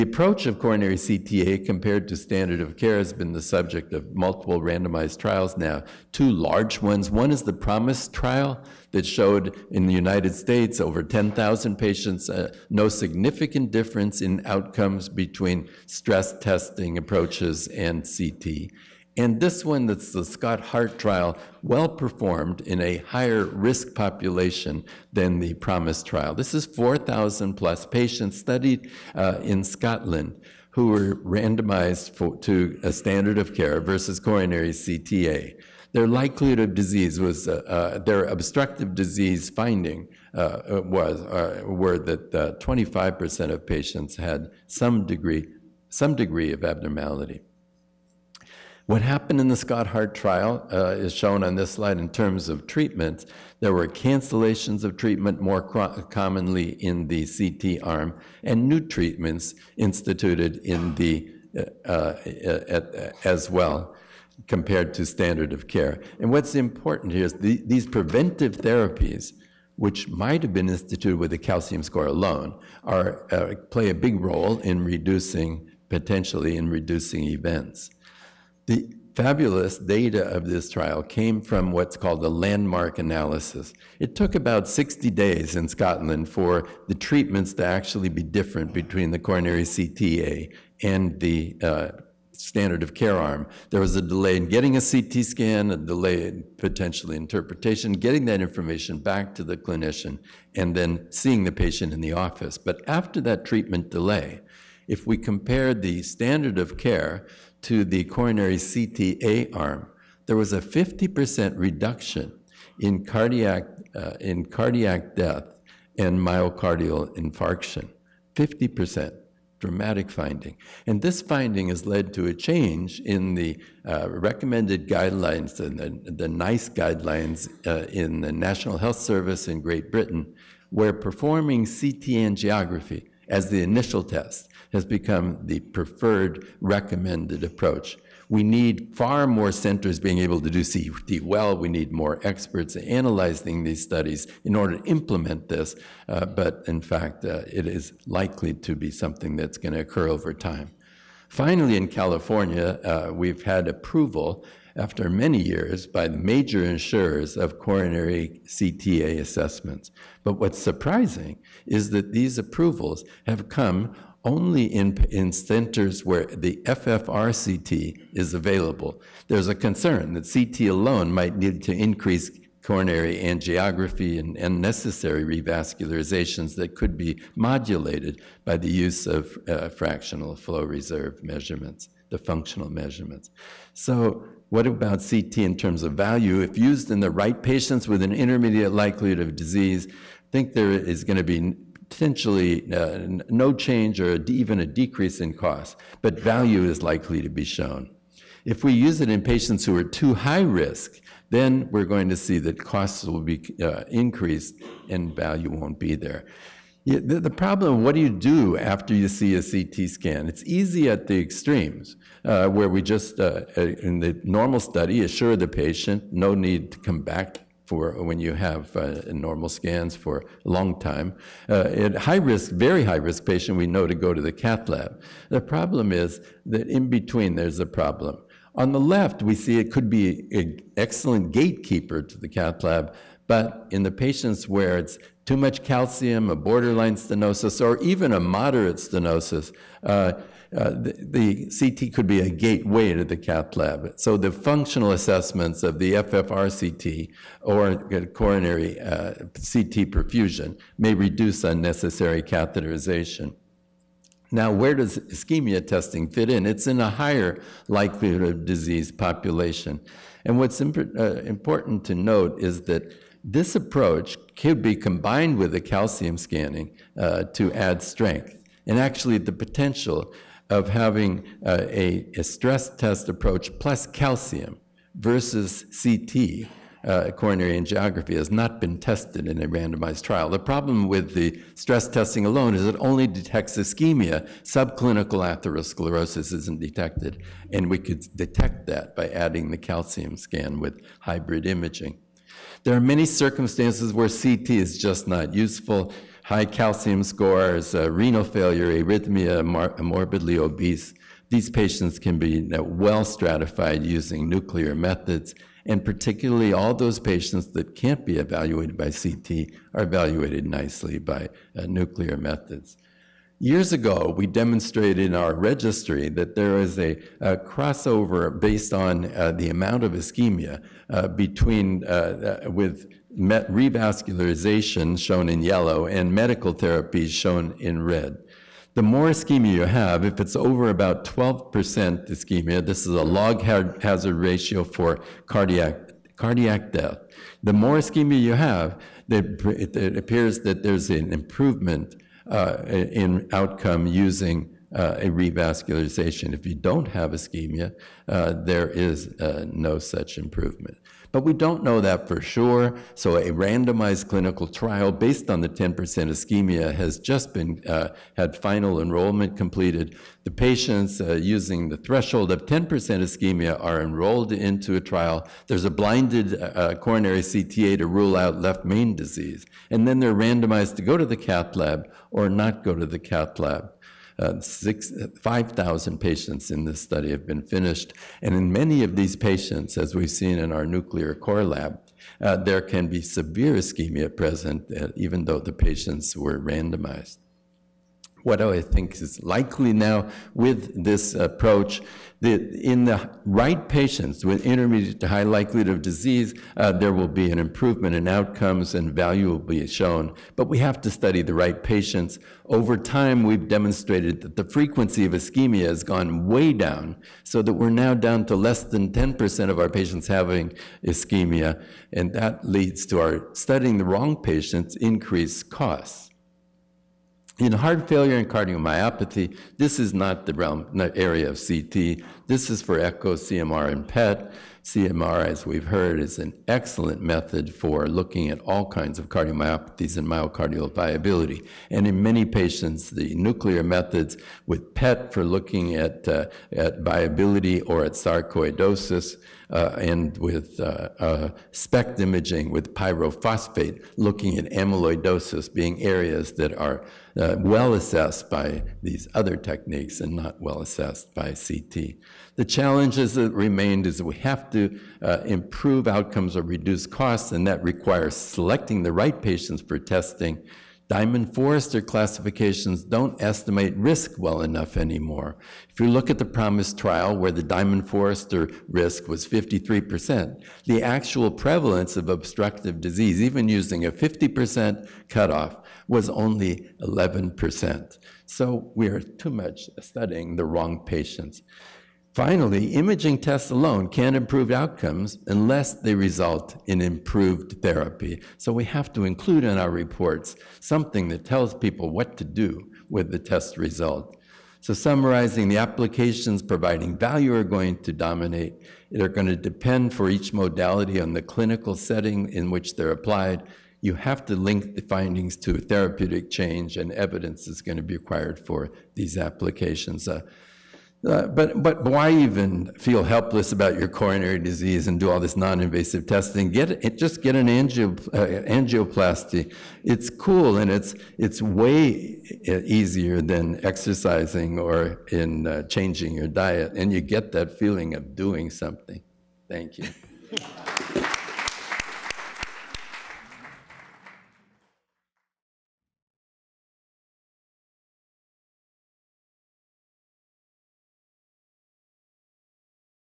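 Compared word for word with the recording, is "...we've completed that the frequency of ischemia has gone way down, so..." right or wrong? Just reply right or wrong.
wrong.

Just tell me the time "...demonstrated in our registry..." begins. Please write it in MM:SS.
05:14.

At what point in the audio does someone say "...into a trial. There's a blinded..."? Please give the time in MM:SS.
06:04.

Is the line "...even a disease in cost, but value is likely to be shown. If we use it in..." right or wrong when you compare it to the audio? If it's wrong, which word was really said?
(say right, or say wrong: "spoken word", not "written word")
wrong: "decrease", not "disease".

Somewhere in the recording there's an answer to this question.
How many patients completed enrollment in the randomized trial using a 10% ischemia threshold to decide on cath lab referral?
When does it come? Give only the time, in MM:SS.
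06:14.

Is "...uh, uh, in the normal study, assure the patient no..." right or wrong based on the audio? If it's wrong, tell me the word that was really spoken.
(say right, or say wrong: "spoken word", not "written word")
right.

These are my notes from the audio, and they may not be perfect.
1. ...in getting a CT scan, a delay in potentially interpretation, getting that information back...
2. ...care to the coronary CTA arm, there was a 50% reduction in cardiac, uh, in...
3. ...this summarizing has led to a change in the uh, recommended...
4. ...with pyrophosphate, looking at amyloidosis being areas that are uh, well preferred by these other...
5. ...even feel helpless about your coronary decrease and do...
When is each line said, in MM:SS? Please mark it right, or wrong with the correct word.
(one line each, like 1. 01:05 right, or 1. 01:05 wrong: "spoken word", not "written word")
1. 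01:34 right
2. 01:46 right
3. 02:01 wrong: "finding", not "summarizing"
4. 07:22 wrong: "assessed", not "preferred"
5. 08:32 wrong: "disease", not "decrease".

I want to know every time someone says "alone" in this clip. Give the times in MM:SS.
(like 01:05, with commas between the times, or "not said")
01:12, 02:50, 04:42, 08:03.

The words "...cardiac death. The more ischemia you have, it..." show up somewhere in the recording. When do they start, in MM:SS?
05:36.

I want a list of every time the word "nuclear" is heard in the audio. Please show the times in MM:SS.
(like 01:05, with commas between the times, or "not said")
05:04, 05:11, 06:20, 07:13.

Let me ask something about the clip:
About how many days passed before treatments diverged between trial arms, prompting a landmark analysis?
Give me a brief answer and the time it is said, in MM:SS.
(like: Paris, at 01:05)
60 days, at 01:24.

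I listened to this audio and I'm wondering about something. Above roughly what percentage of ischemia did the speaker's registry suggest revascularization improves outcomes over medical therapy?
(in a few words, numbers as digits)
12%.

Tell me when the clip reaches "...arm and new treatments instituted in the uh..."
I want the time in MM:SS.
00:57.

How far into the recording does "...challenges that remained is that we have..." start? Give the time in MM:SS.
07:32.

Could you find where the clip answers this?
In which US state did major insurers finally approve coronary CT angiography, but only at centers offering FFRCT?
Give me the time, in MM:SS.
02:31.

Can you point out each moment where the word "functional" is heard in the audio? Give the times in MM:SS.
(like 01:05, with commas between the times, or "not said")
03:02, 04:04.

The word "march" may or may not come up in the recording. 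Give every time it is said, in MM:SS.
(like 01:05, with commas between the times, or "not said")
not said.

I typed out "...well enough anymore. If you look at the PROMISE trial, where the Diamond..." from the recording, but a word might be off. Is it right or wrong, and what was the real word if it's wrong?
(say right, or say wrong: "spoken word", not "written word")
right.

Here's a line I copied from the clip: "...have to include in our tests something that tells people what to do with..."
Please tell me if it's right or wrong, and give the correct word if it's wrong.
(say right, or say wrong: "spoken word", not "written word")
wrong: "reports", not "tests".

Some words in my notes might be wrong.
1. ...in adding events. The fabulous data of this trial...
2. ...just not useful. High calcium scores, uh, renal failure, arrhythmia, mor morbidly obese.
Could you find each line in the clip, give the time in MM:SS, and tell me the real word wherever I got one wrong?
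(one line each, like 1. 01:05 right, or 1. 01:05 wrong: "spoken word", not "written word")
1. 01:16 wrong: "reducing", not "adding"
2. 04:54 right.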